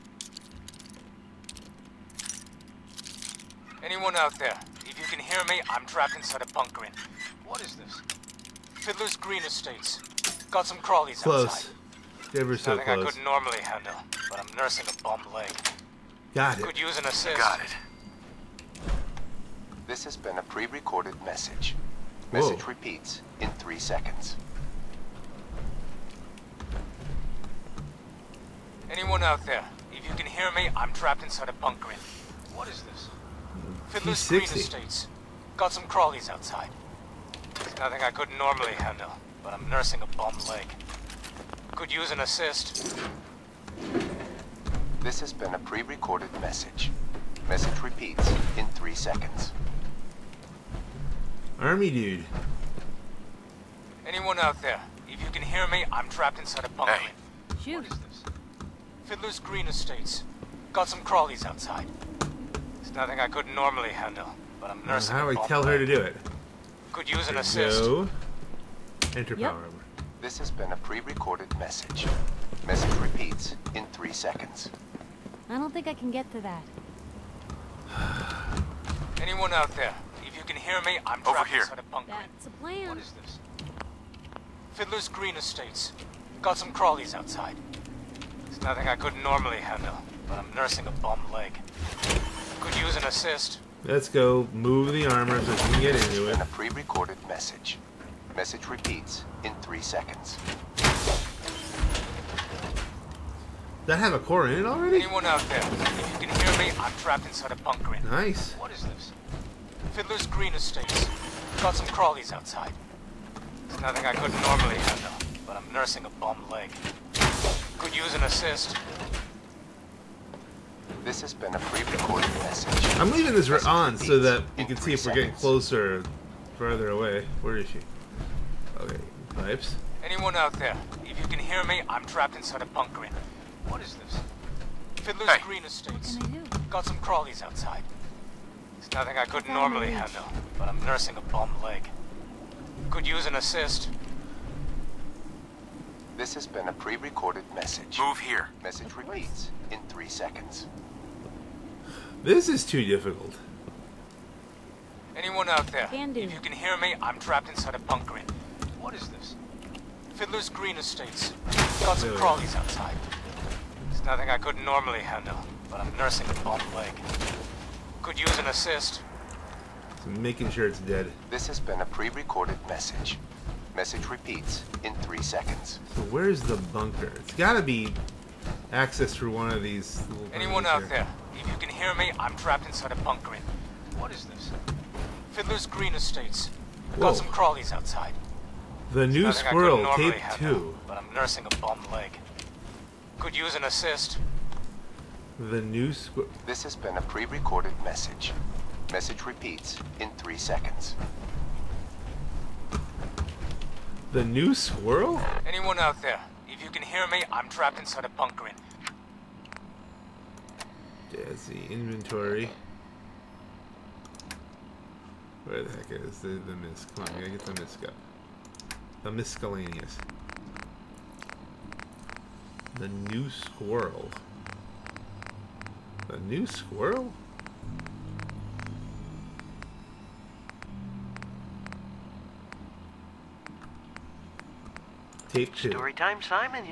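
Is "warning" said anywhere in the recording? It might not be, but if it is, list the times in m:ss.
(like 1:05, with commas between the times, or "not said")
not said.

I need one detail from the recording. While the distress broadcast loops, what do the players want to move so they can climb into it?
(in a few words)
armor.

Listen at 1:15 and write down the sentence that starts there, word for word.
I don't think I can get to that.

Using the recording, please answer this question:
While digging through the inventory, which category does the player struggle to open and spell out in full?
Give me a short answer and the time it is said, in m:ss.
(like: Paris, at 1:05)
miscellaneous, at 3:39.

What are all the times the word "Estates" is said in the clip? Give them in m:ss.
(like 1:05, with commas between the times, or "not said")
0:09, 0:34, 0:59, 1:25, 1:50, 2:15, 2:40, 3:05.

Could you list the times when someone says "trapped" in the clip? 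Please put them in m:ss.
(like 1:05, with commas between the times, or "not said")
0:05, 0:30, 0:56, 1:47, 2:12, 2:37, 3:02, 3:27.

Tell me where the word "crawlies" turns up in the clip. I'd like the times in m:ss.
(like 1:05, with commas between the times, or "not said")
0:10, 0:35, 1:01, 1:26, 1:51, 2:16, 2:42, 3:07.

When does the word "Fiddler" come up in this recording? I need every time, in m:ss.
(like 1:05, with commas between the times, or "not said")
0:08, 0:33, 0:59, 1:24, 1:49, 2:15, 2:40, 3:05.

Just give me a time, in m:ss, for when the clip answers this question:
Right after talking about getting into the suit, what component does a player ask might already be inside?
1:44.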